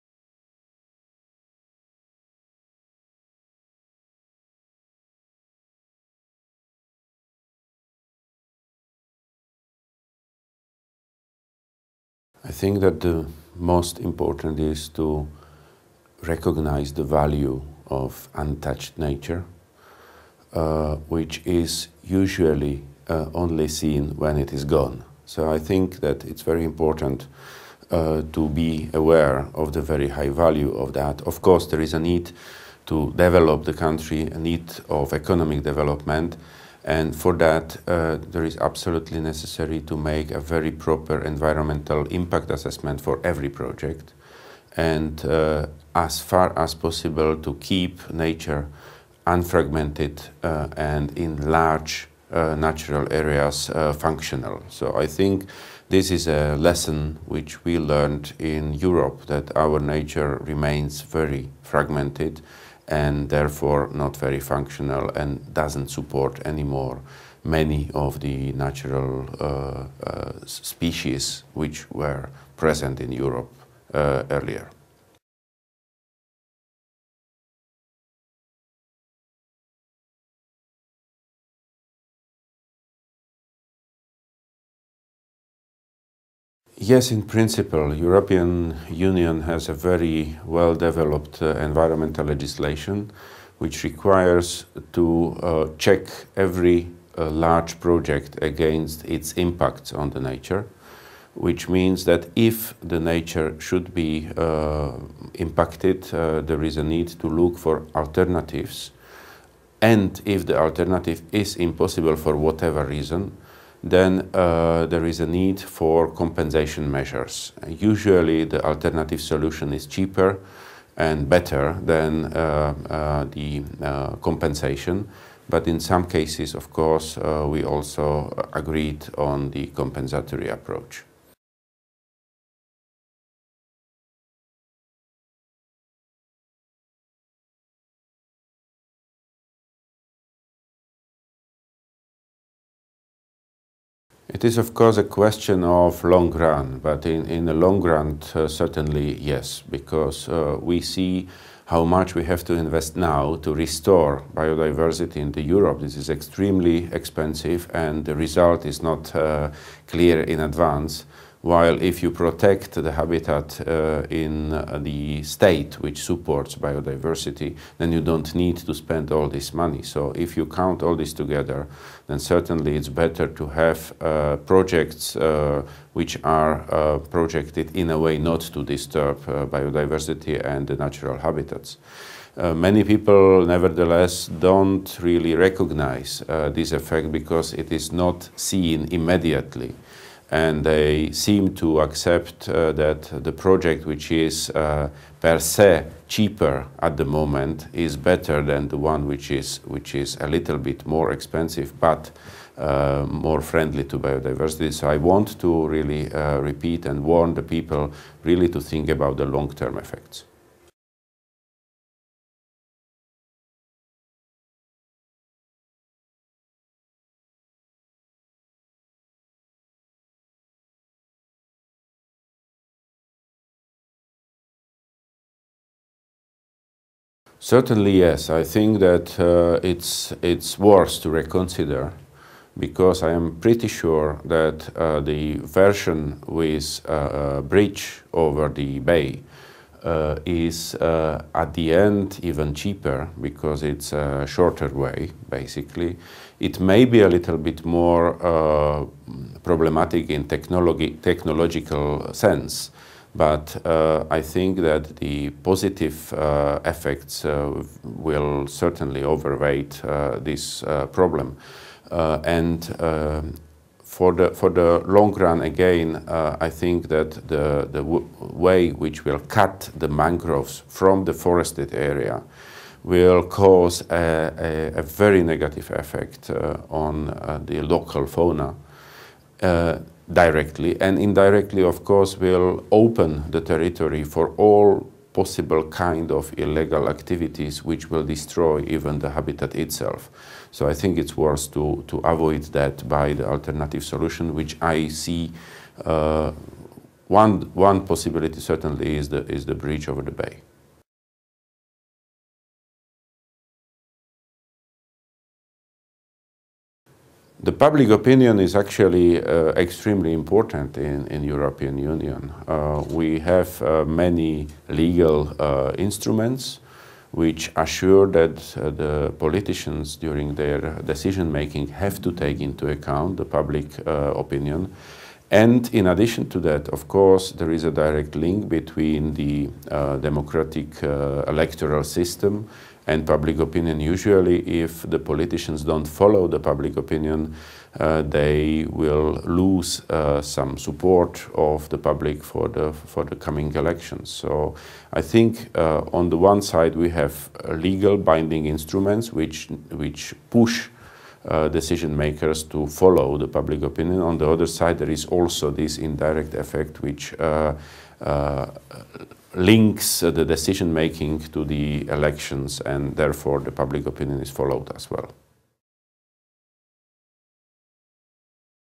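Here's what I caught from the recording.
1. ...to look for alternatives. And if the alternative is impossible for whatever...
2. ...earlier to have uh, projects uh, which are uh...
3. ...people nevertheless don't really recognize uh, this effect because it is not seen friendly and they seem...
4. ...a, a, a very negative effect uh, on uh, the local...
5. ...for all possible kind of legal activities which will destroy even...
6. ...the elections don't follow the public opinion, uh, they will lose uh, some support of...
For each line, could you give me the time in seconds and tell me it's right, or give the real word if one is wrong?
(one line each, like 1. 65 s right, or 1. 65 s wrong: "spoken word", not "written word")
1. 107 s right
2. 172 s wrong: "better", not "earlier"
3. 182 s wrong: "immediately", not "friendly"
4. 273 s right
5. 284 s wrong: "illegal", not "legal"
6. 334 s wrong: "politicians", not "elections".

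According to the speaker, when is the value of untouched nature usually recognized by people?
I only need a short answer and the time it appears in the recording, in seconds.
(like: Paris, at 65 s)
When it is gone, at 23 s.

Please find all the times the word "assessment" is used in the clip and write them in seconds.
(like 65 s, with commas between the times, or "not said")
42 s.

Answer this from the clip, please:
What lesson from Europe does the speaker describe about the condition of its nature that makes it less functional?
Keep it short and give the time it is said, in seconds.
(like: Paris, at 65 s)
Very fragmented, at 61 s.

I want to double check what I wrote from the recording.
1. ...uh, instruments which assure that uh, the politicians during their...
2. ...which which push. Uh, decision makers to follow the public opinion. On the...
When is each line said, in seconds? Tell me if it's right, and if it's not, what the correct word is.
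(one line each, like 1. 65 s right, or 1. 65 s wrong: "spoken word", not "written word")
1. 315 s right
2. 349 s right.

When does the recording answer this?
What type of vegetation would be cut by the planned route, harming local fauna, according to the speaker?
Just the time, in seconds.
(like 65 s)
269 s.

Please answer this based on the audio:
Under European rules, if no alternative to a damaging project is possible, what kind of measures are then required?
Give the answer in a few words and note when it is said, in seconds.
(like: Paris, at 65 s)
Compensation measures, at 116 s.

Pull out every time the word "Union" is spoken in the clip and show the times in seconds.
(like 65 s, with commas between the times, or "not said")
88 s, 311 s.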